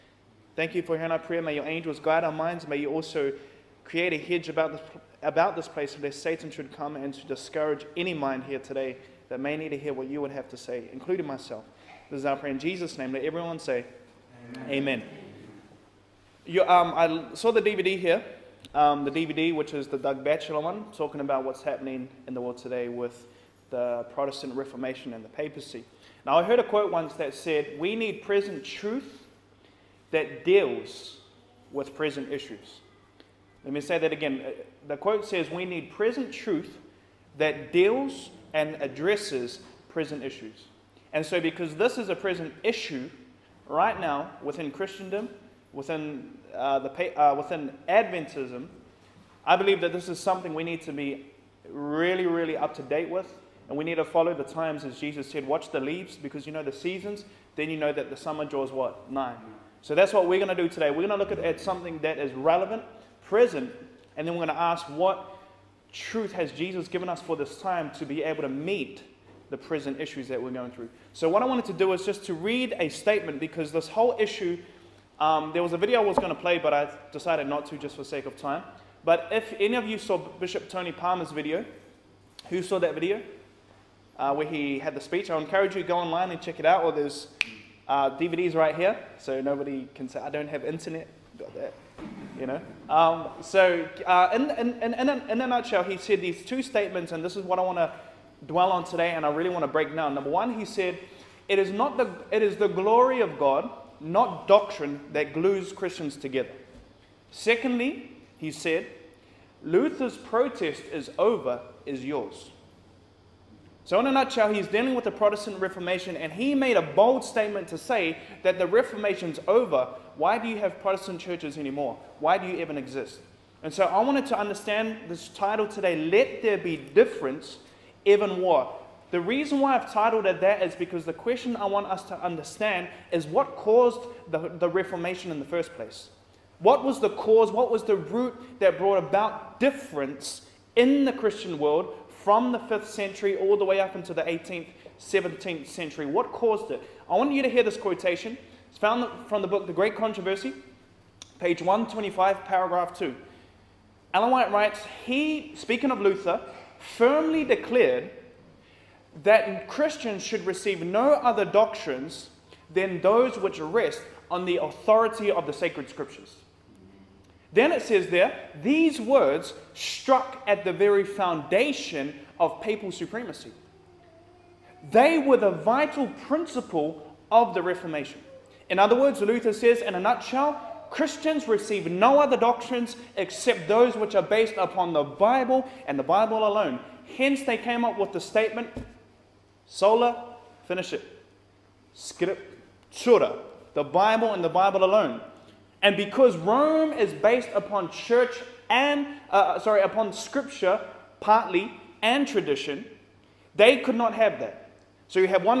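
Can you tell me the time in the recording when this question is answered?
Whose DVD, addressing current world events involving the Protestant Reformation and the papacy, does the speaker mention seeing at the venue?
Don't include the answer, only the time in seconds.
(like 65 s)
19 s.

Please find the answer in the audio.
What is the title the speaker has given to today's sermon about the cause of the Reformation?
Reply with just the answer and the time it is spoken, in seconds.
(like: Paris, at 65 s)
Let There Be Difference, Even War, at 126 s.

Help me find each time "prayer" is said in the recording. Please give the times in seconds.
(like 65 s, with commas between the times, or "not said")
1 s, 12 s.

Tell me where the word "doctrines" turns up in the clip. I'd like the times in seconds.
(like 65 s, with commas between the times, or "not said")
104 s, 161 s, 182 s.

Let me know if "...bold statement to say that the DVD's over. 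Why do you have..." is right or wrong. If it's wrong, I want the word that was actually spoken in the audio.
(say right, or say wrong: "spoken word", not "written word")
wrong: "Reformation", not "DVD".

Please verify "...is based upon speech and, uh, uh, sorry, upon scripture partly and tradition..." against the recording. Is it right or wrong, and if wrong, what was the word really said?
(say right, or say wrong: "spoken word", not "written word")
wrong: "church", not "speech".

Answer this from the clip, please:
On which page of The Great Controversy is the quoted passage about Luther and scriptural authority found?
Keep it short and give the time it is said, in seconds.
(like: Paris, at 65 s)
125, at 151 s.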